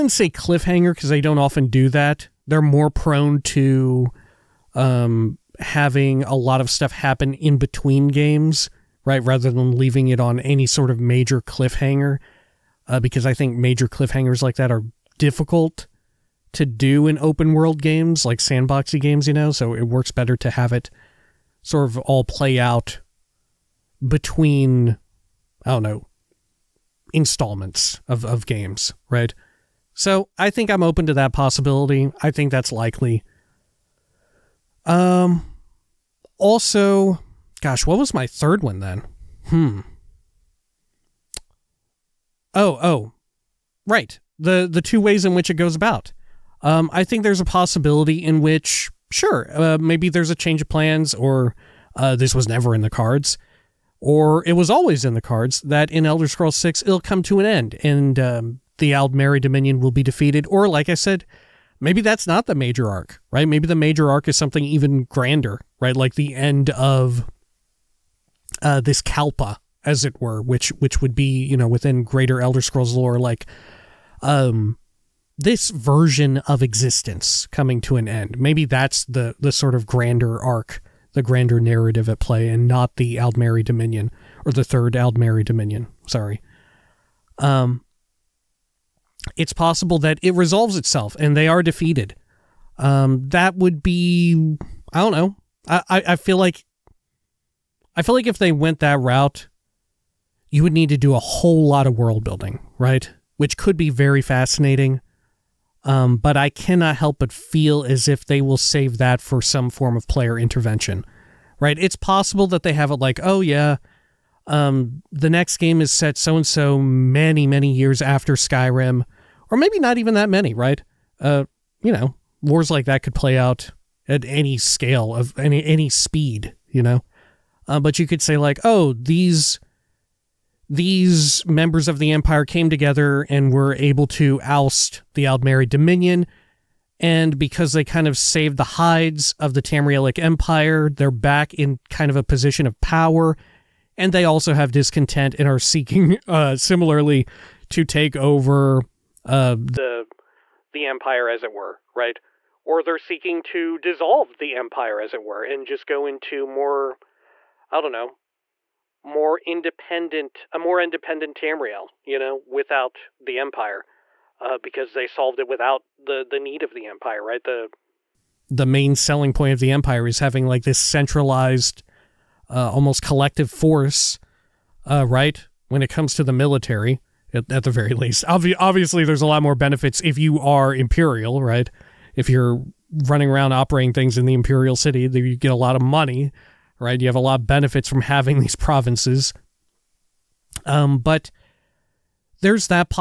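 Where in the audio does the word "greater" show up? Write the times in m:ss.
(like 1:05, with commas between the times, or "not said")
1:12.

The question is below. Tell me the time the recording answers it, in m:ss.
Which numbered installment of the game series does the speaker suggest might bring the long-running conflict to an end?
0:56.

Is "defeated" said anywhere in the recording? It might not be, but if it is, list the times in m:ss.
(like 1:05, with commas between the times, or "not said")
1:00, 1:31.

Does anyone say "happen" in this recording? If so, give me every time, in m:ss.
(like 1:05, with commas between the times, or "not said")
0:06.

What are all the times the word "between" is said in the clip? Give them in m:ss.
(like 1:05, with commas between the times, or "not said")
0:07, 0:24.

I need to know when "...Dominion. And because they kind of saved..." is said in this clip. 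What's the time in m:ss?
2:15.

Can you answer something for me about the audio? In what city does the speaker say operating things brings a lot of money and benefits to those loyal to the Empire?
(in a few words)
Imperial City.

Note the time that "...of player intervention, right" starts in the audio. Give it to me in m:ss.
1:49.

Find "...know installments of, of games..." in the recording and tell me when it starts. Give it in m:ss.
0:25.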